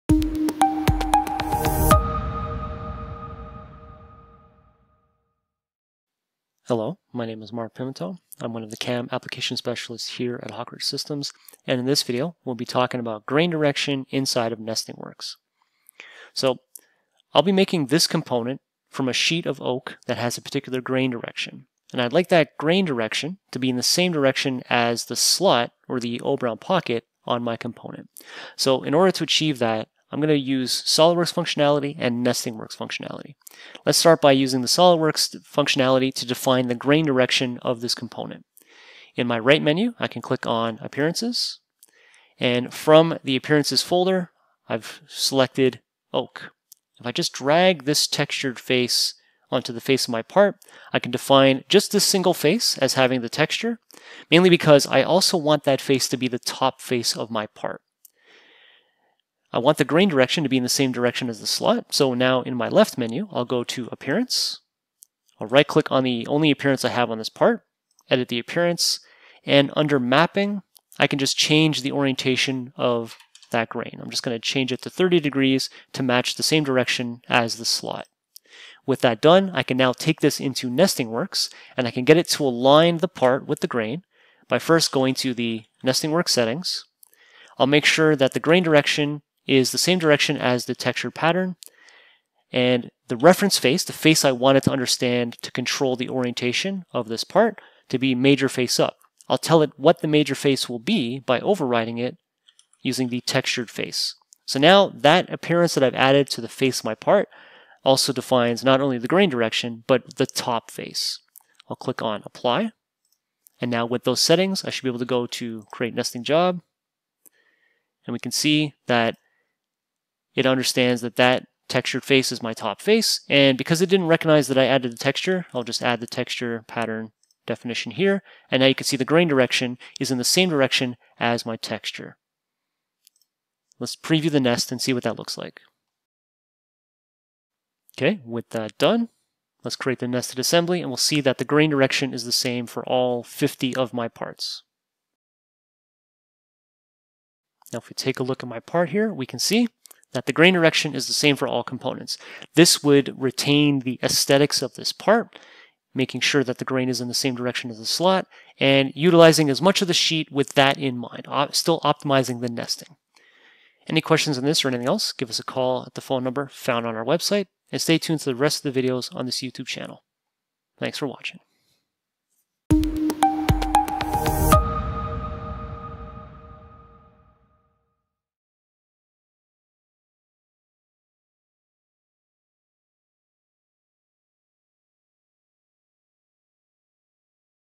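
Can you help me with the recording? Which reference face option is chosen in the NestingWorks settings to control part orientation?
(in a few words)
Major face up.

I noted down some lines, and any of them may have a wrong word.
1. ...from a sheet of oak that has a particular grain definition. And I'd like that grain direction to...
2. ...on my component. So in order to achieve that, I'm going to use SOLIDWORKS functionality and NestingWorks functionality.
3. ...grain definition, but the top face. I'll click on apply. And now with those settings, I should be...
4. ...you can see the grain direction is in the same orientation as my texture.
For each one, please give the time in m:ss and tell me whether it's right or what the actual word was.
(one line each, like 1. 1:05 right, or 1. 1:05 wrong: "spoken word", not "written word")
1. 0:18 wrong: "direction", not "definition"
2. 0:27 right
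3. 1:49 wrong: "direction", not "definition"
4. 2:08 wrong: "direction", not "orientation".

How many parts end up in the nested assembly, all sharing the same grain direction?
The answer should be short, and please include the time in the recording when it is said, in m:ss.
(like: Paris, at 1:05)
50, at 2:23.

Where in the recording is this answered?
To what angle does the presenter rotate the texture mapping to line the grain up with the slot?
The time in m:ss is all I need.
1:14.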